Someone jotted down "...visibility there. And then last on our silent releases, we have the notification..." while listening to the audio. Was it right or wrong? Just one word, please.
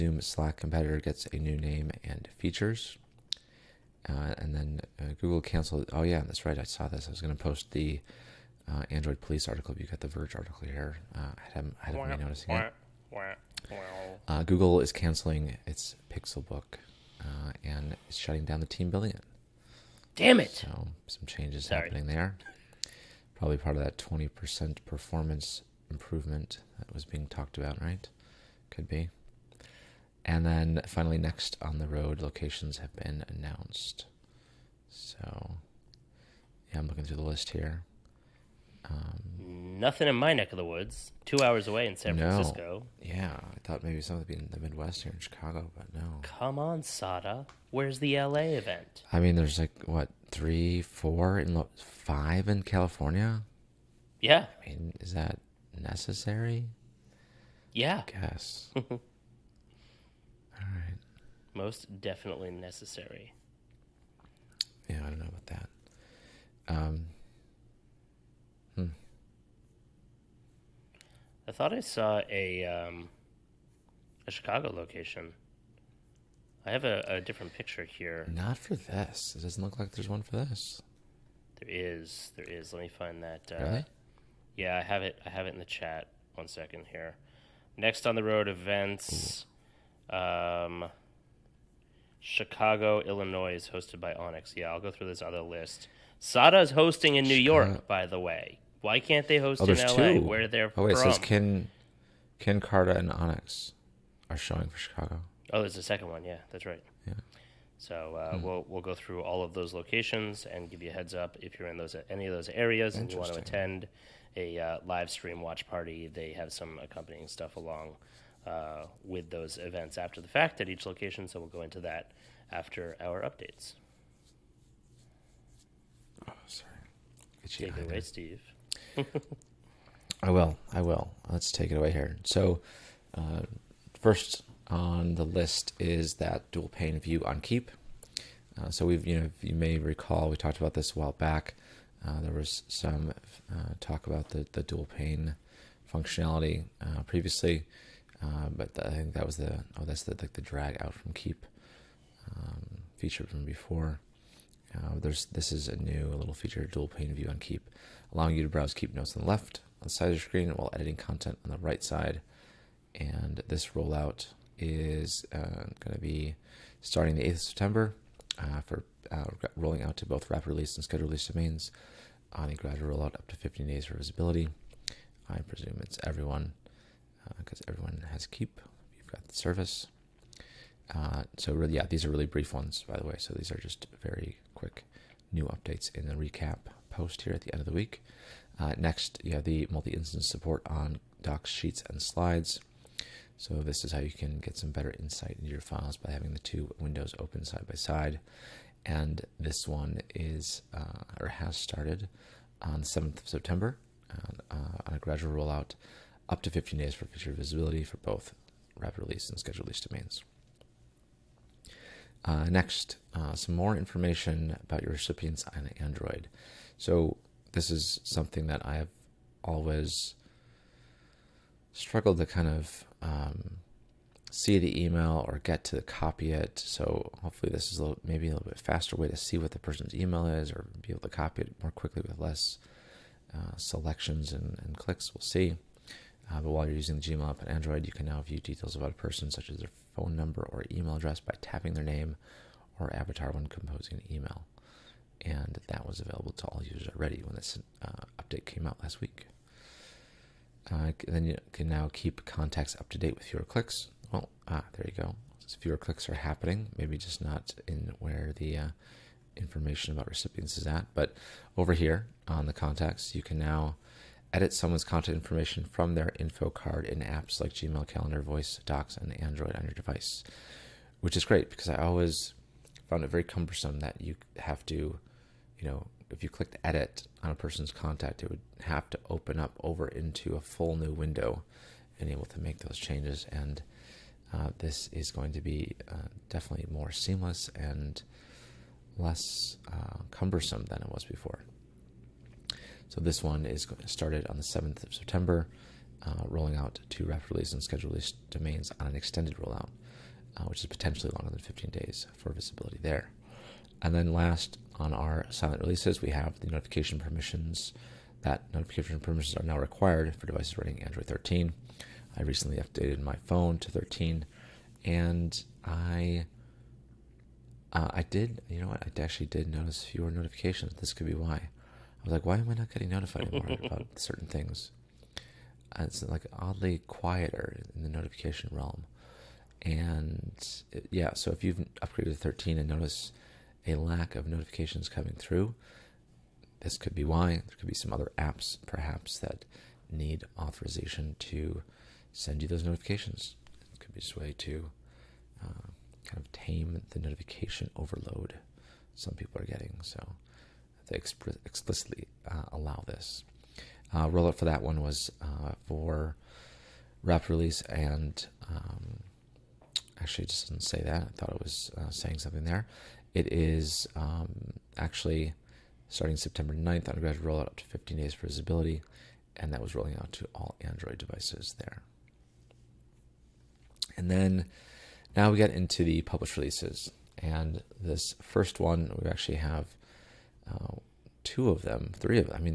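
right.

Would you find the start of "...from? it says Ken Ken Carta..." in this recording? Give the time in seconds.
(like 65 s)
100 s.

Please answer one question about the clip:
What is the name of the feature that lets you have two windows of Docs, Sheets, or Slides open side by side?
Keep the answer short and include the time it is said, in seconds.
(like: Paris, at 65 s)
multi-instance support, at 189 s.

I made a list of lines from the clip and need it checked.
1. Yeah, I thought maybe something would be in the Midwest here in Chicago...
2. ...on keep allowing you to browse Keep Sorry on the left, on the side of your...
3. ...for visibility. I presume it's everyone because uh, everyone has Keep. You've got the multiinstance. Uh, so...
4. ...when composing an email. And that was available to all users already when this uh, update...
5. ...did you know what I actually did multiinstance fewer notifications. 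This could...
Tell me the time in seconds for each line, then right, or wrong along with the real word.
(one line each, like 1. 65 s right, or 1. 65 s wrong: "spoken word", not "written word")
1. 43 s right
2. 157 s wrong: "Notes", not "Sorry"
3. 173 s wrong: "service", not "multiinstance"
4. 243 s right
5. 318 s wrong: "notice", not "multiinstance".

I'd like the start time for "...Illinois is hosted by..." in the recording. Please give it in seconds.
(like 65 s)
93 s.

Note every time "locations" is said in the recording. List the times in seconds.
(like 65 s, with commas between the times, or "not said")
32 s, 74 s, 109 s, 120 s.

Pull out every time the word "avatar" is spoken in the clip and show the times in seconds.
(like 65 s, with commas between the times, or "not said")
242 s.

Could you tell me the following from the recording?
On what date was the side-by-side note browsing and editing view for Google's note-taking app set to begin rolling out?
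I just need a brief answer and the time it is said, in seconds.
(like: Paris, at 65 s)
September 8, at 167 s.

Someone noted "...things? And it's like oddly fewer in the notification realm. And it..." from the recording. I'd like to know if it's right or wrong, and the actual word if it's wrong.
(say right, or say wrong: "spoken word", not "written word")
wrong: "quieter", not "fewer".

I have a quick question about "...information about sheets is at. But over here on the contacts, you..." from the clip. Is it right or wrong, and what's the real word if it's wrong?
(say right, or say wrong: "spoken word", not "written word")
wrong: "recipients", not "sheets".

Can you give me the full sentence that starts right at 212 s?
Uh, next, uh, some more information about your recipients on Android.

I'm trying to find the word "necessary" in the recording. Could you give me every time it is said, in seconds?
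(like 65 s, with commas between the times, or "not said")
55 s, 62 s.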